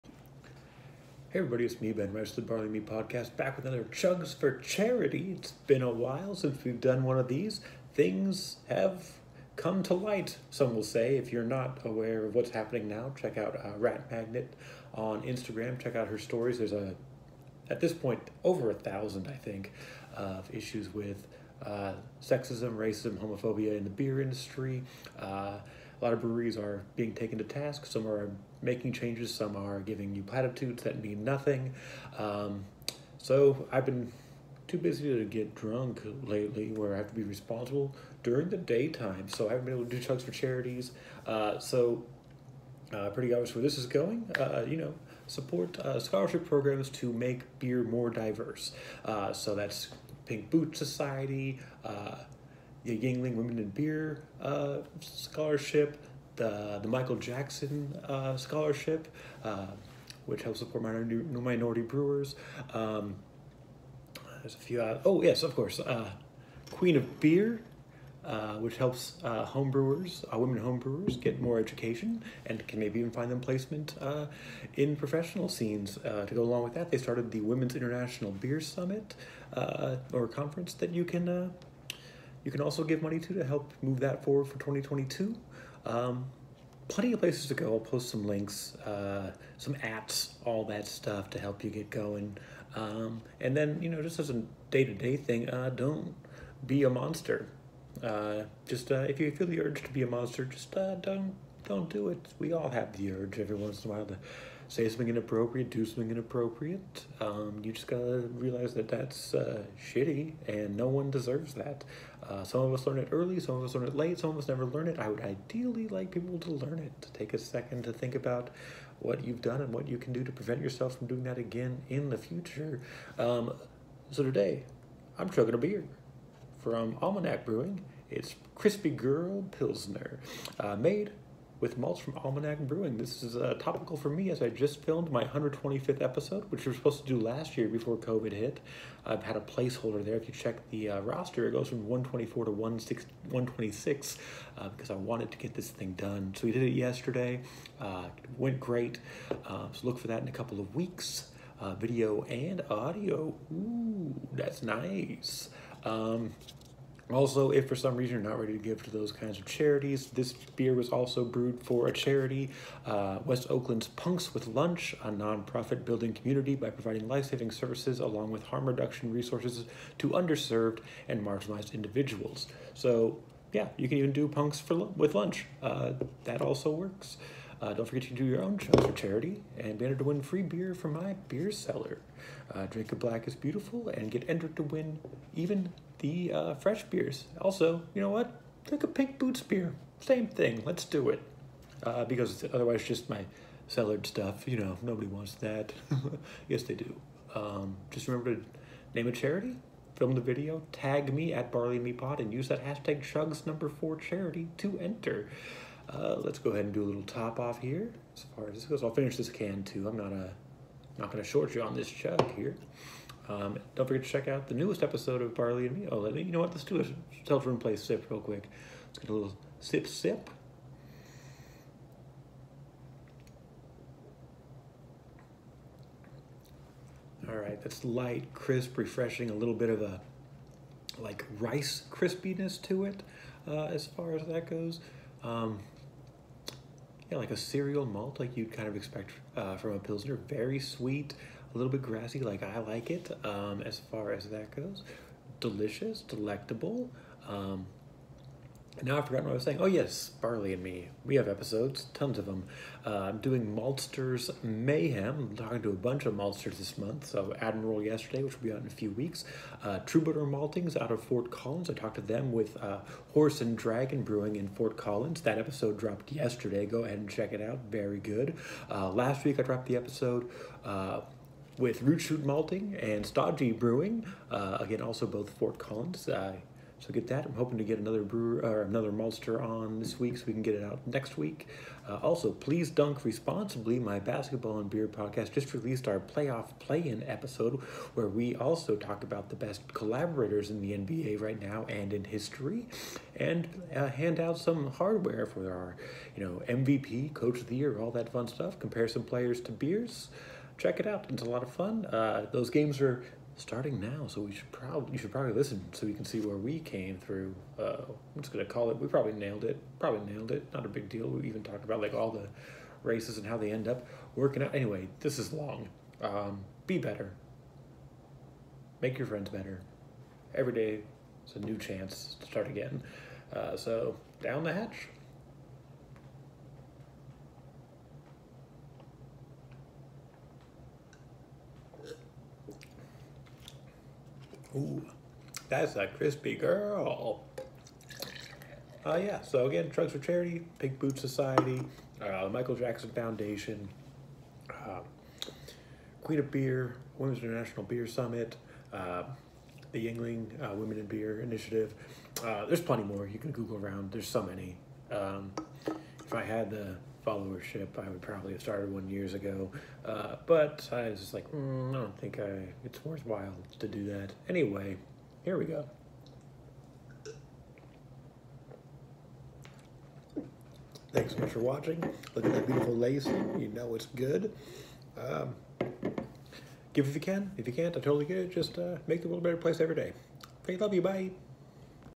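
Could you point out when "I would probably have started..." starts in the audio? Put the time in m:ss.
5:57.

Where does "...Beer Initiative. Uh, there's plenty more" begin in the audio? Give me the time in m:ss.
5:50.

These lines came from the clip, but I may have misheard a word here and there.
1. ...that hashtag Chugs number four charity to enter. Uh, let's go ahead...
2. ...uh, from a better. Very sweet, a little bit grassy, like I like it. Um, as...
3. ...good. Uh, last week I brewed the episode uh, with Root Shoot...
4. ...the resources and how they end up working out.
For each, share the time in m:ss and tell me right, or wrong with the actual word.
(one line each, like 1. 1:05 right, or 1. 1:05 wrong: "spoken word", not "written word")
1. 3:22 right
2. 3:59 wrong: "pilsner", not "better"
3. 4:27 wrong: "dropped", not "brewed"
4. 5:12 wrong: "races", not "resources".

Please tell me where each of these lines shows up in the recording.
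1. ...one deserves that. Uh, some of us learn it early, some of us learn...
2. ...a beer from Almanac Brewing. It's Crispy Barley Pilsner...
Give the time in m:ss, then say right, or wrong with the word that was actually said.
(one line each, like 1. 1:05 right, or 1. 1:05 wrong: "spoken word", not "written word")
1. 1:50 right
2. 2:05 wrong: "Grrrl", not "Barley".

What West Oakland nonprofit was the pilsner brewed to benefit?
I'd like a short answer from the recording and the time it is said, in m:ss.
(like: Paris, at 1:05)
Punks with Lunch, at 2:43.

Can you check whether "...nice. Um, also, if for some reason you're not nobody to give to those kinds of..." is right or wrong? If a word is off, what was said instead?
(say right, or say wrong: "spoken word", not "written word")
wrong: "ready", not "nobody".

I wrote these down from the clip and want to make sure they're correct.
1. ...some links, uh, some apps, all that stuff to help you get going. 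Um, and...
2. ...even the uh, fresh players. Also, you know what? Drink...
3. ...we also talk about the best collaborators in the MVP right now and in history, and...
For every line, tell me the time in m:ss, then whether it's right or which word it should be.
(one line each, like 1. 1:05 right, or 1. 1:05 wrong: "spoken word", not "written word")
1. 1:28 right
2. 3:05 wrong: "beers", not "players"
3. 4:48 wrong: "NBA", not "MVP".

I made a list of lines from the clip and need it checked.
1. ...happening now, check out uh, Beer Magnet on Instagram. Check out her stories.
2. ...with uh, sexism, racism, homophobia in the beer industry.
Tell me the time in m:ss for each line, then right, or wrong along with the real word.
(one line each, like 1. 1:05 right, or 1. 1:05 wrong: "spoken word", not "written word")
1. 0:12 wrong: "Rat", not "Beer"
2. 0:20 right.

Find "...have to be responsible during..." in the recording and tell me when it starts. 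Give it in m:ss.
0:36.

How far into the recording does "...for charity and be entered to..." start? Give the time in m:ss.
2:58.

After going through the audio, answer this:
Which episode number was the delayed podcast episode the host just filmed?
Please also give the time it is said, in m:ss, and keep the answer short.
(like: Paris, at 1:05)
125th, at 2:15.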